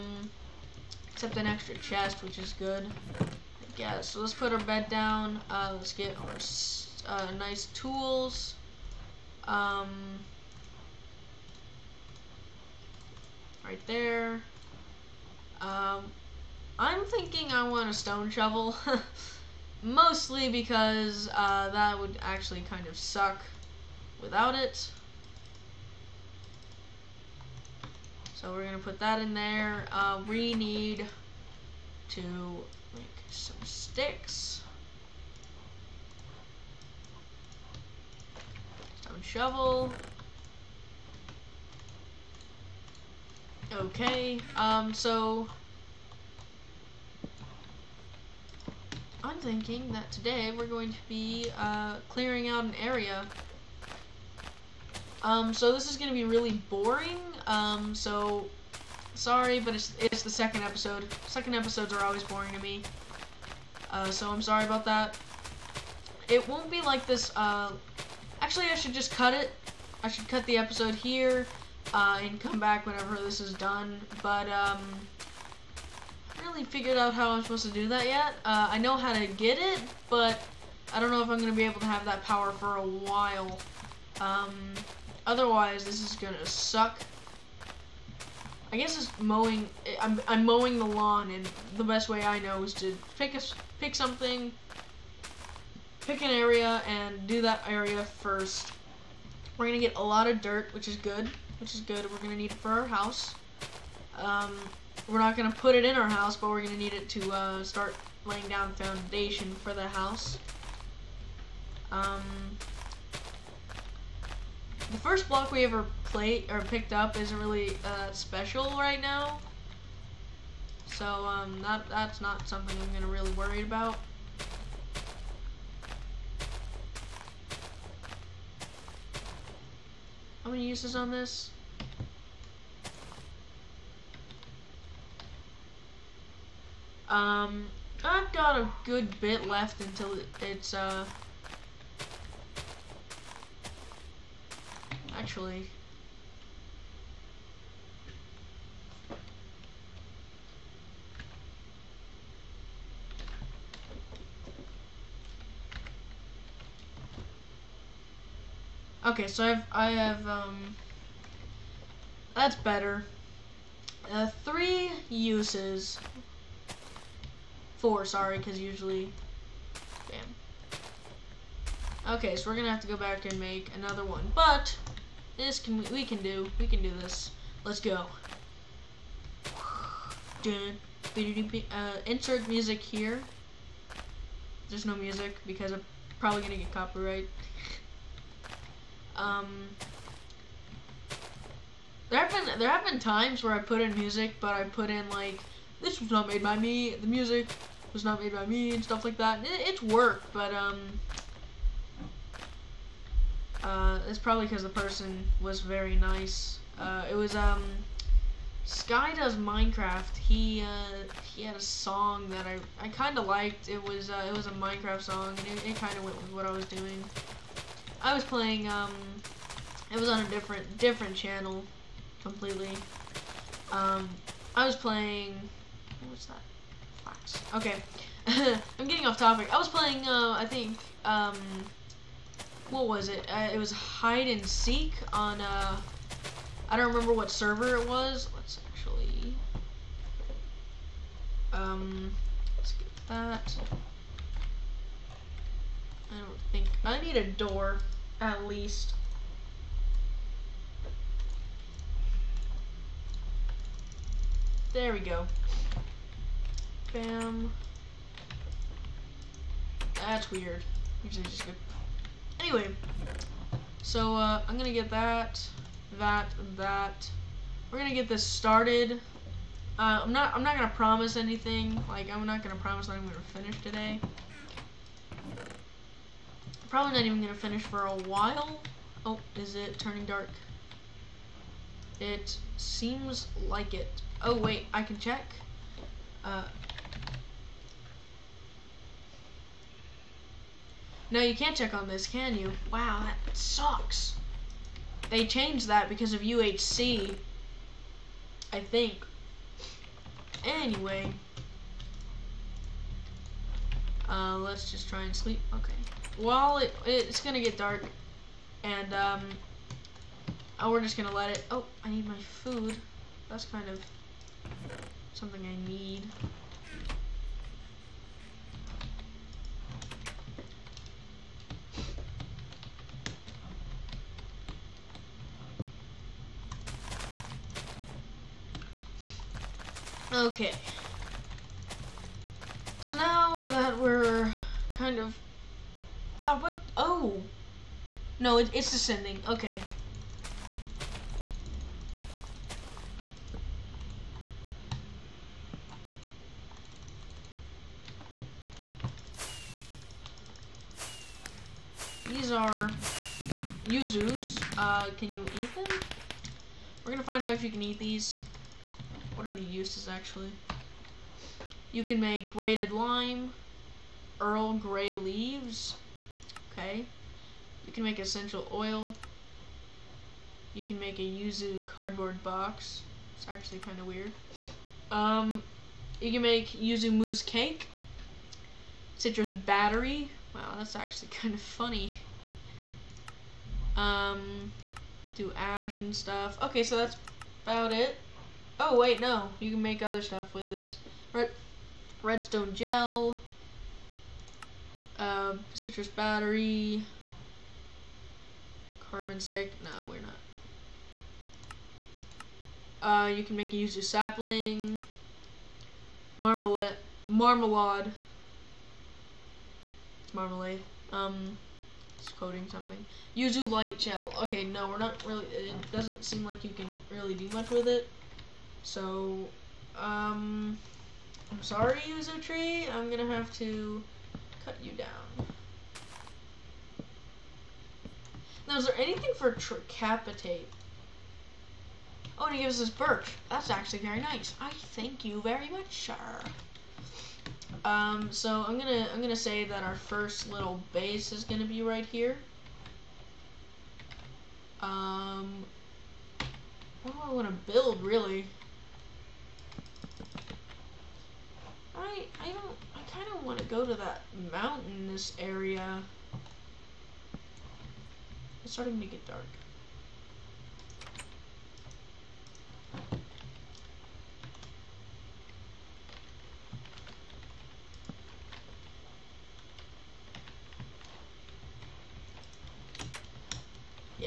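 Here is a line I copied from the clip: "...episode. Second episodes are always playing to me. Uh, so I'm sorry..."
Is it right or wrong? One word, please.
wrong.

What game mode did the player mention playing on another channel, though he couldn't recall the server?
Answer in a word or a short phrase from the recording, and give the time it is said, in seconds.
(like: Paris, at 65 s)
Hide and seek, at 233 s.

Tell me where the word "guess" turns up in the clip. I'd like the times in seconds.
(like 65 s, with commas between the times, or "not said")
3 s, 88 s.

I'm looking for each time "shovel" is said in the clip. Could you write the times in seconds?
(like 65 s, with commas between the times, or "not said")
18 s, 39 s.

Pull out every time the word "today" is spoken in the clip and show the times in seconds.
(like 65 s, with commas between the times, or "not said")
50 s, 273 s.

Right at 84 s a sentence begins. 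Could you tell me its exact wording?
Um, otherwise, this is going to suck.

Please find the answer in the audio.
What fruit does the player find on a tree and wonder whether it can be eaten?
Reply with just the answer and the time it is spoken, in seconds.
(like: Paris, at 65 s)
Yuzus, at 353 s.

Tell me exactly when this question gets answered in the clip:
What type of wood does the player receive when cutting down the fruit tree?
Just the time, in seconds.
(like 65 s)
432 s.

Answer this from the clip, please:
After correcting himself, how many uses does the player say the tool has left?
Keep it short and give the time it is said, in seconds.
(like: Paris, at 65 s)
4, at 167 s.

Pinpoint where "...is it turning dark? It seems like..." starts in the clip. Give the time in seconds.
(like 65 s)
279 s.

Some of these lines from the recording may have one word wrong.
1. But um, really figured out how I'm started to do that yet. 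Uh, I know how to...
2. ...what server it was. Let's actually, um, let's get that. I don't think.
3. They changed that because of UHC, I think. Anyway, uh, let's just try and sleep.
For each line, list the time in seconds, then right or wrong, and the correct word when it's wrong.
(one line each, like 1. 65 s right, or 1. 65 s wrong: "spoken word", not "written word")
1. 74 s wrong: "supposed", not "started"
2. 237 s right
3. 295 s right.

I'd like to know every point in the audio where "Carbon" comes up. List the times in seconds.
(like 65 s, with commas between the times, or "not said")
398 s.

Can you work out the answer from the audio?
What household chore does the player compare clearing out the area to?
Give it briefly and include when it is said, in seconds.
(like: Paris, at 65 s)
Mowing the lawn, at 90 s.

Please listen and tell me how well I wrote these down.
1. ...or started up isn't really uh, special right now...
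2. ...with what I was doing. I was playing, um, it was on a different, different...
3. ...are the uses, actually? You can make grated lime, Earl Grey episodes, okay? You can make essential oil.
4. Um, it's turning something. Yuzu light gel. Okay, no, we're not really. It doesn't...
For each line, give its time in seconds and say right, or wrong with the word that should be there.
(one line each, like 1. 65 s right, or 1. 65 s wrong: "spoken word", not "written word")
1. 116 s wrong: "picked", not "started"
2. 216 s right
3. 359 s wrong: "leaves", not "episodes"
4. 410 s wrong: "coding", not "turning".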